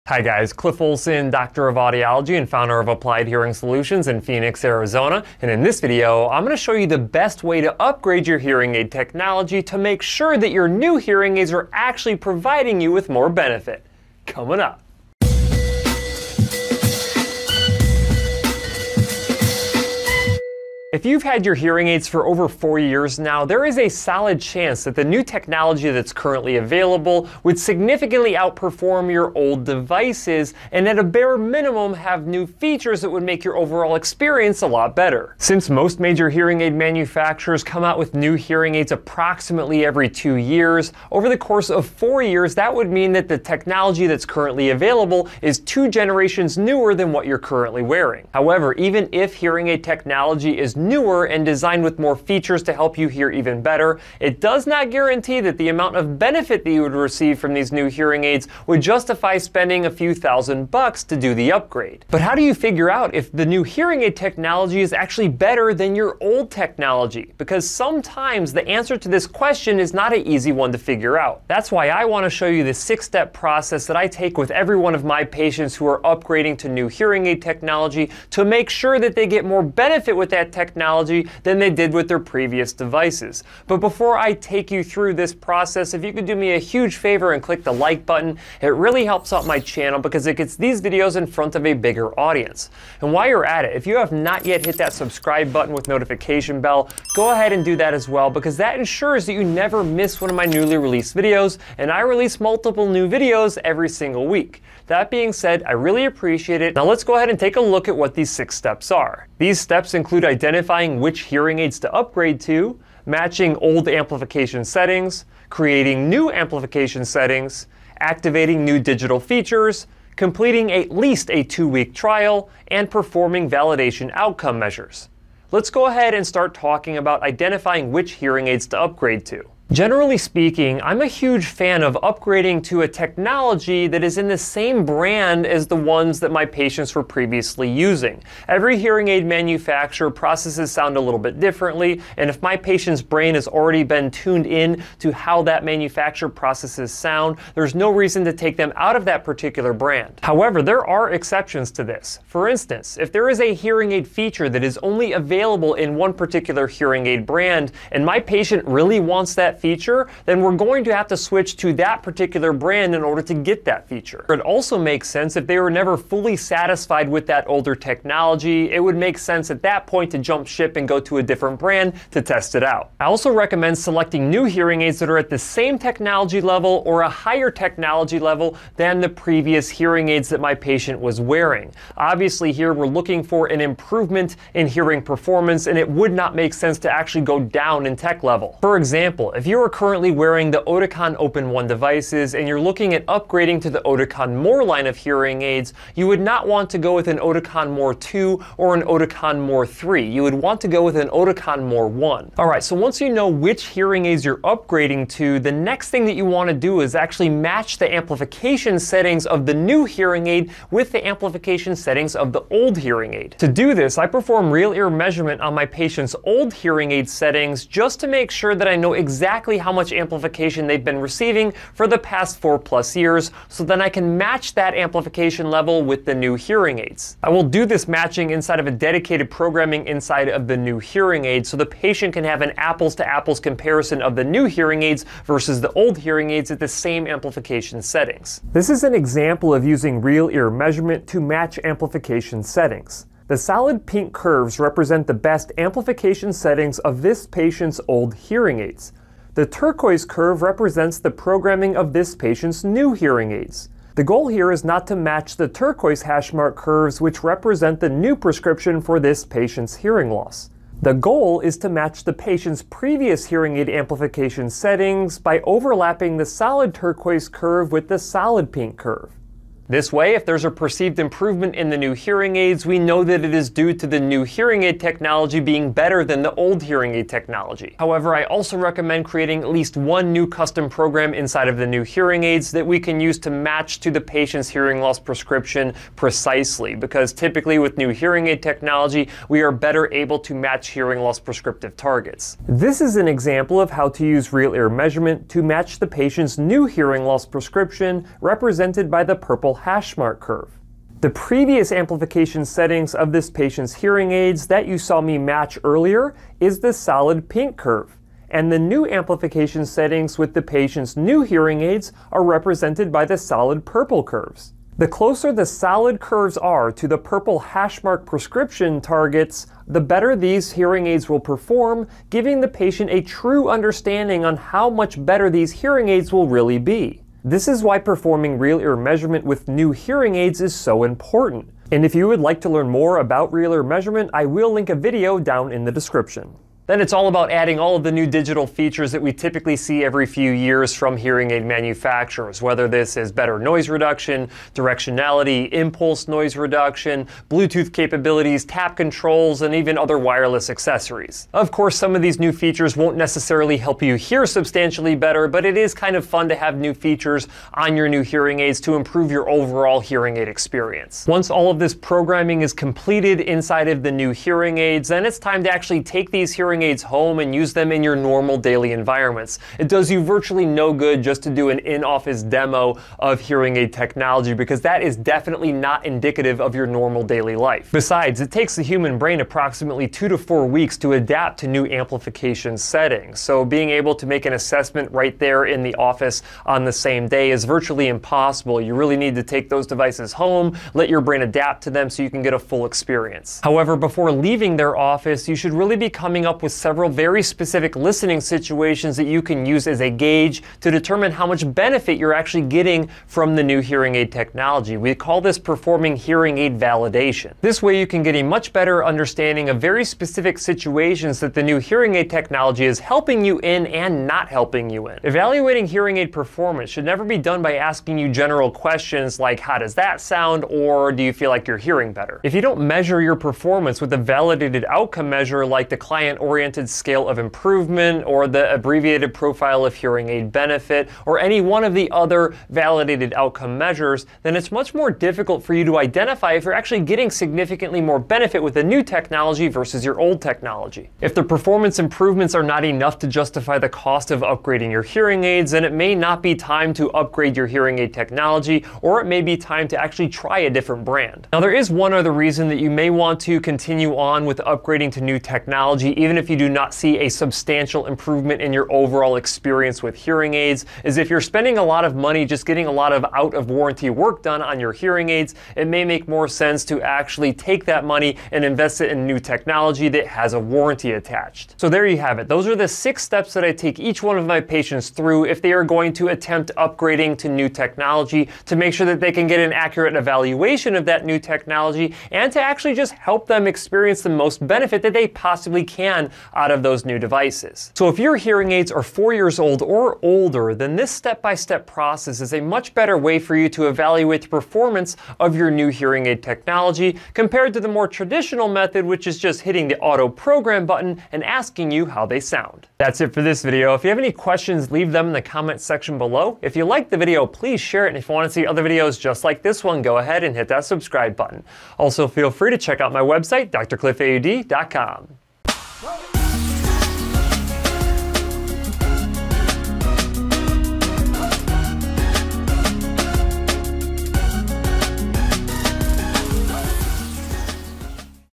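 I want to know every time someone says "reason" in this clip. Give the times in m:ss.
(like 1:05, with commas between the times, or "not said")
2:27, 7:32.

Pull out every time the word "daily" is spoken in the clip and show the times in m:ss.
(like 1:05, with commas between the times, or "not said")
6:08, 6:17.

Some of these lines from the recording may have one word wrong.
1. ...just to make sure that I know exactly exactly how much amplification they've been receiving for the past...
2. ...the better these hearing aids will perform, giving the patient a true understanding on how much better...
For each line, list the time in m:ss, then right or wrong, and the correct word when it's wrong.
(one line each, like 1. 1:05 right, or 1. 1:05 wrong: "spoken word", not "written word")
1. 3:37 right
2. 5:19 right.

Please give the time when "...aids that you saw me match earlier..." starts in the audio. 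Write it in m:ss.
5:04.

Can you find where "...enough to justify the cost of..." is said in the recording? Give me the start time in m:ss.
7:22.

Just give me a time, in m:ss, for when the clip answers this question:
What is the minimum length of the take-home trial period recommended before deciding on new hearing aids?
2:01.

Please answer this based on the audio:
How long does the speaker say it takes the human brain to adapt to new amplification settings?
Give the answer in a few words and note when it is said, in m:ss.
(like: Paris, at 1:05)
2 to 4 weeks, at 6:19.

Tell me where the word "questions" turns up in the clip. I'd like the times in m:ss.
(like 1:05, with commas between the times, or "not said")
1:09, 6:58, 8:24.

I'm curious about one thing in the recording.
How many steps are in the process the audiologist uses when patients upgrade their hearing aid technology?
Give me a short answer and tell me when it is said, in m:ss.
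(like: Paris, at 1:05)
6, at 1:12.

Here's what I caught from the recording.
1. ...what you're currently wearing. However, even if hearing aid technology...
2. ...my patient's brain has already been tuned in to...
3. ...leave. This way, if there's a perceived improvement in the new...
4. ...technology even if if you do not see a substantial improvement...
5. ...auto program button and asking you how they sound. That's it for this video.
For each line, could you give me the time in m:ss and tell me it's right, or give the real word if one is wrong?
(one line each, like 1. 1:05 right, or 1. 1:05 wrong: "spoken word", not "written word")
1. 0:47 right
2. 2:22 right
3. 4:28 wrong: "curve", not "leave"
4. 7:35 right
5. 8:19 right.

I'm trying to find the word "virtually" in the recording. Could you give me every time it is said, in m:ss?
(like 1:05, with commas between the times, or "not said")
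6:10, 6:27.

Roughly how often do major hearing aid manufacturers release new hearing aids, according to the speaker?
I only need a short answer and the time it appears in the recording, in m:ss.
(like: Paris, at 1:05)
every 2 years, at 0:38.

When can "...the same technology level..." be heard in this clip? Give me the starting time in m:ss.
2:55.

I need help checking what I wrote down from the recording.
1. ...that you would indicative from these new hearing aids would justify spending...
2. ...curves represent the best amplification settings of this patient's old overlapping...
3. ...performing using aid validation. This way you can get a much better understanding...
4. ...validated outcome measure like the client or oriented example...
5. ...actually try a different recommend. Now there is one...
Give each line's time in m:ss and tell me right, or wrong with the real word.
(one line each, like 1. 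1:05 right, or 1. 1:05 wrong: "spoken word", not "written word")
1. 0:56 wrong: "receive", not "indicative"
2. 4:04 wrong: "hearing", not "overlapping"
3. 6:45 wrong: "hearing", not "using"
4. 7:03 wrong: "scale", not "example"
5. 7:29 wrong: "brand", not "recommend".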